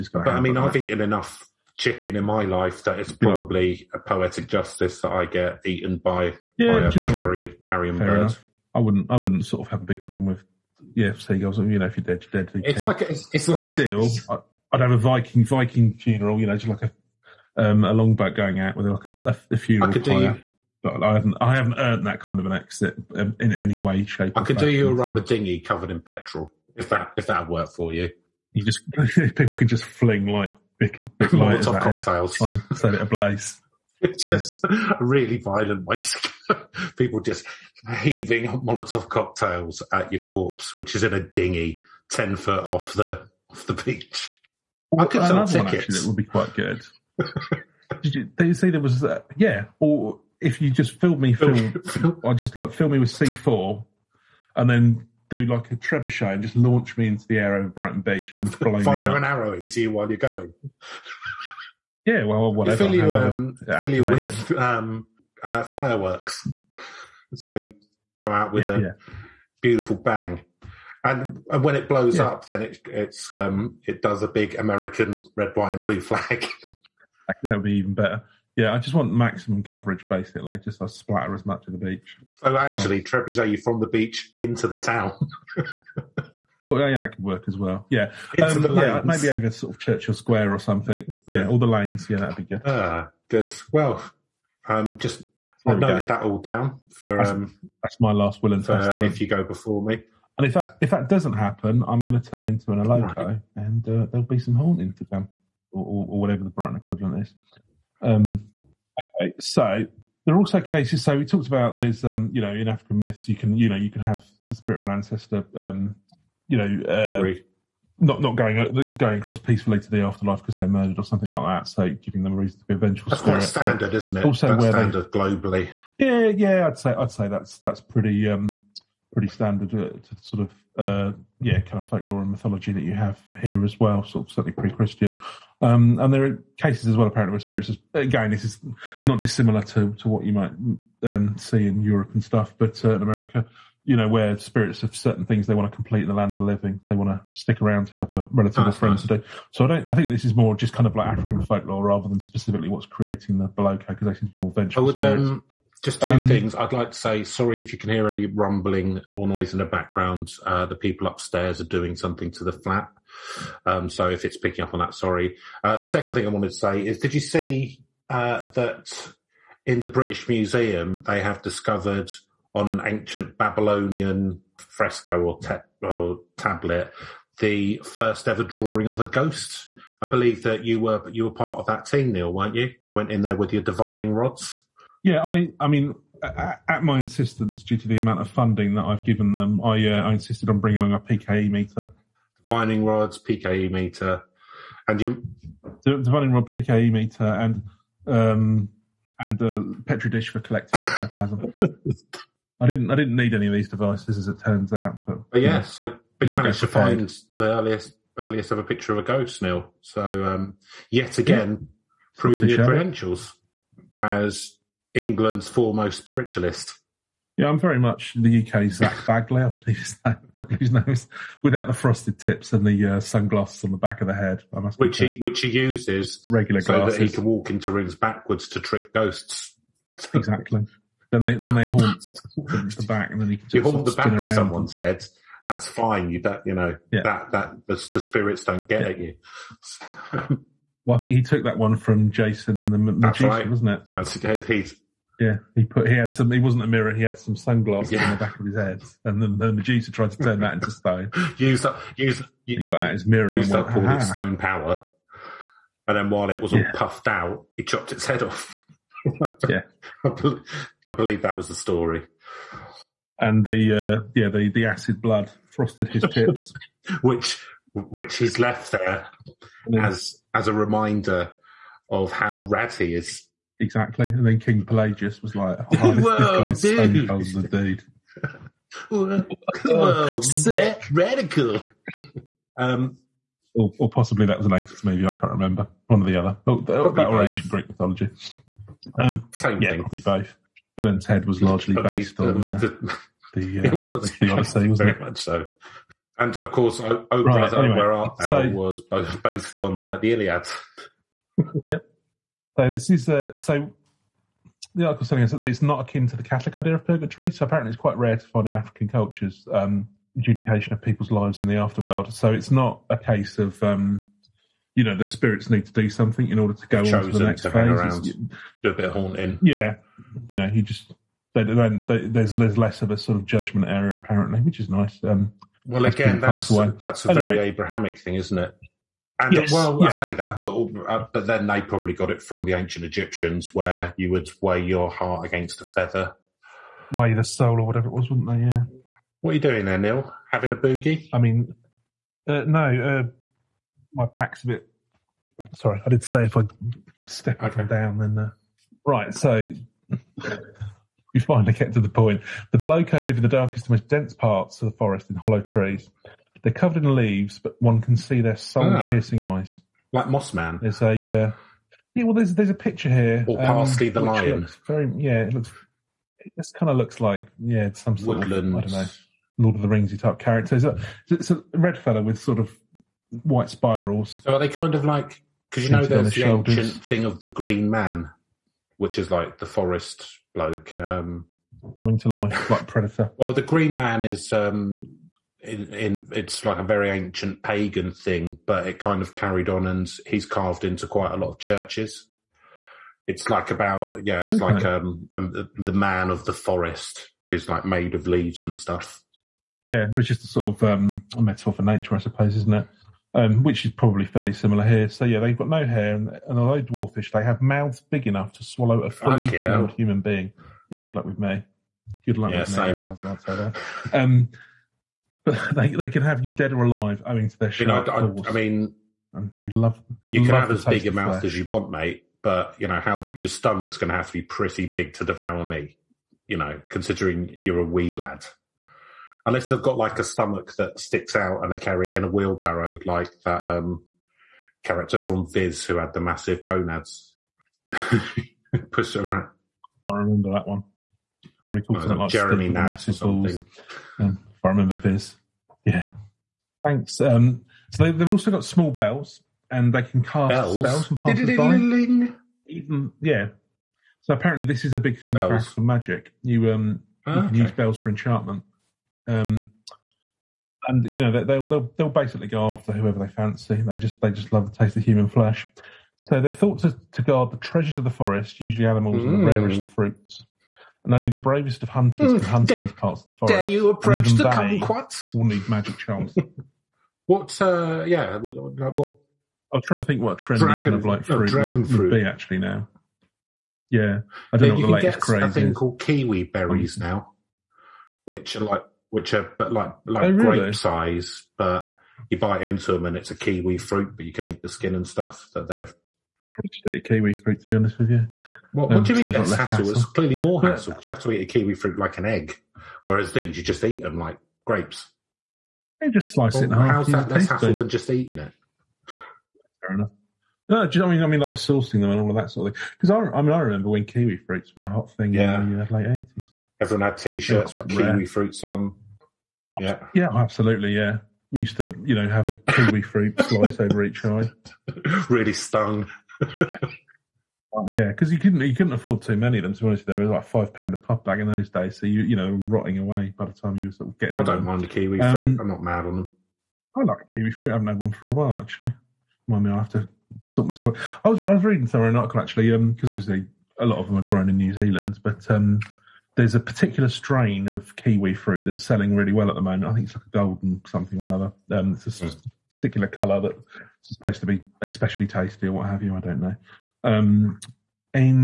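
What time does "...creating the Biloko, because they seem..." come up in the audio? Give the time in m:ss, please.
2:32.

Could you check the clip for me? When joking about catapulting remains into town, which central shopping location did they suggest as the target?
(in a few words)
Churchill Square.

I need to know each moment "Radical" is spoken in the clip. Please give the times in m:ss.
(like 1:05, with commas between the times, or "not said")
4:40.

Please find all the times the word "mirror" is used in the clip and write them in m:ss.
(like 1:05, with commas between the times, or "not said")
4:06, 4:13.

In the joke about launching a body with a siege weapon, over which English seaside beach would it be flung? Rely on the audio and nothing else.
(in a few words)
Brighton Beach.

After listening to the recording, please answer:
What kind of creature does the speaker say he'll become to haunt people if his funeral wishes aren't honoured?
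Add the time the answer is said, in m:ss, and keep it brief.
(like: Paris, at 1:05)
an Eloko, at 1:42.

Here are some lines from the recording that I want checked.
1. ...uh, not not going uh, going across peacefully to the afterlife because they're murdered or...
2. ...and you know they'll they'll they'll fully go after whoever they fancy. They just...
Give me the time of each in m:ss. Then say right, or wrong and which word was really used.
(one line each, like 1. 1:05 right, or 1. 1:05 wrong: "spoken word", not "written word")
1. 1:56 right
2. 7:40 wrong: "basically", not "fully".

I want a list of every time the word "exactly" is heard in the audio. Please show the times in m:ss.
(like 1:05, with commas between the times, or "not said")
3:50, 4:33.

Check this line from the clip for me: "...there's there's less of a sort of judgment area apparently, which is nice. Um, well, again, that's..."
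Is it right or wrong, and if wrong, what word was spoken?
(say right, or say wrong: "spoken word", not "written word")
right.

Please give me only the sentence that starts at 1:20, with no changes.
Just I splatter as much of the beach.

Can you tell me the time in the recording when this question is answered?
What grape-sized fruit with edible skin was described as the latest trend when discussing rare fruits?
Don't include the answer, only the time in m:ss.
8:05.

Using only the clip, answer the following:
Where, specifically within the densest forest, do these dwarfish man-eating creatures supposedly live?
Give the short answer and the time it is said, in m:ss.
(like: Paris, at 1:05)
hollow trees, at 5:55.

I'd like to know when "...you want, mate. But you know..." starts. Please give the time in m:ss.
7:01.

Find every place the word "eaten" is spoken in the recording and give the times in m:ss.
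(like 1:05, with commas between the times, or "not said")
0:00, 0:05.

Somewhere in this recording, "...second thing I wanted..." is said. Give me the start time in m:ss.
2:45.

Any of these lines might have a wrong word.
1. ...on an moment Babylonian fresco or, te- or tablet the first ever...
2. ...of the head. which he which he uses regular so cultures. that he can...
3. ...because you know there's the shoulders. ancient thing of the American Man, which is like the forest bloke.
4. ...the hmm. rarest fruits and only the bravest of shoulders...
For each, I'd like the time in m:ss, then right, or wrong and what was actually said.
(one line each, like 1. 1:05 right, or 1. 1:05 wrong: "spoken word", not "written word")
1. 2:52 wrong: "ancient", not "moment"
2. 3:43 wrong: "glasses", not "cultures"
3. 6:15 wrong: "Green", not "American"
4. 7:49 wrong: "hunters", not "shoulders".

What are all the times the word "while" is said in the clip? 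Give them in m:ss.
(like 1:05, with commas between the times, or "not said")
0:59, 4:16, 8:58.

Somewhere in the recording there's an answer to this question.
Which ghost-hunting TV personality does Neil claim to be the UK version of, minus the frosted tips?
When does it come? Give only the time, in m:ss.
3:38.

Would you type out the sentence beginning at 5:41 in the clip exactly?
I mean, uh, no, uh, my back's a bit.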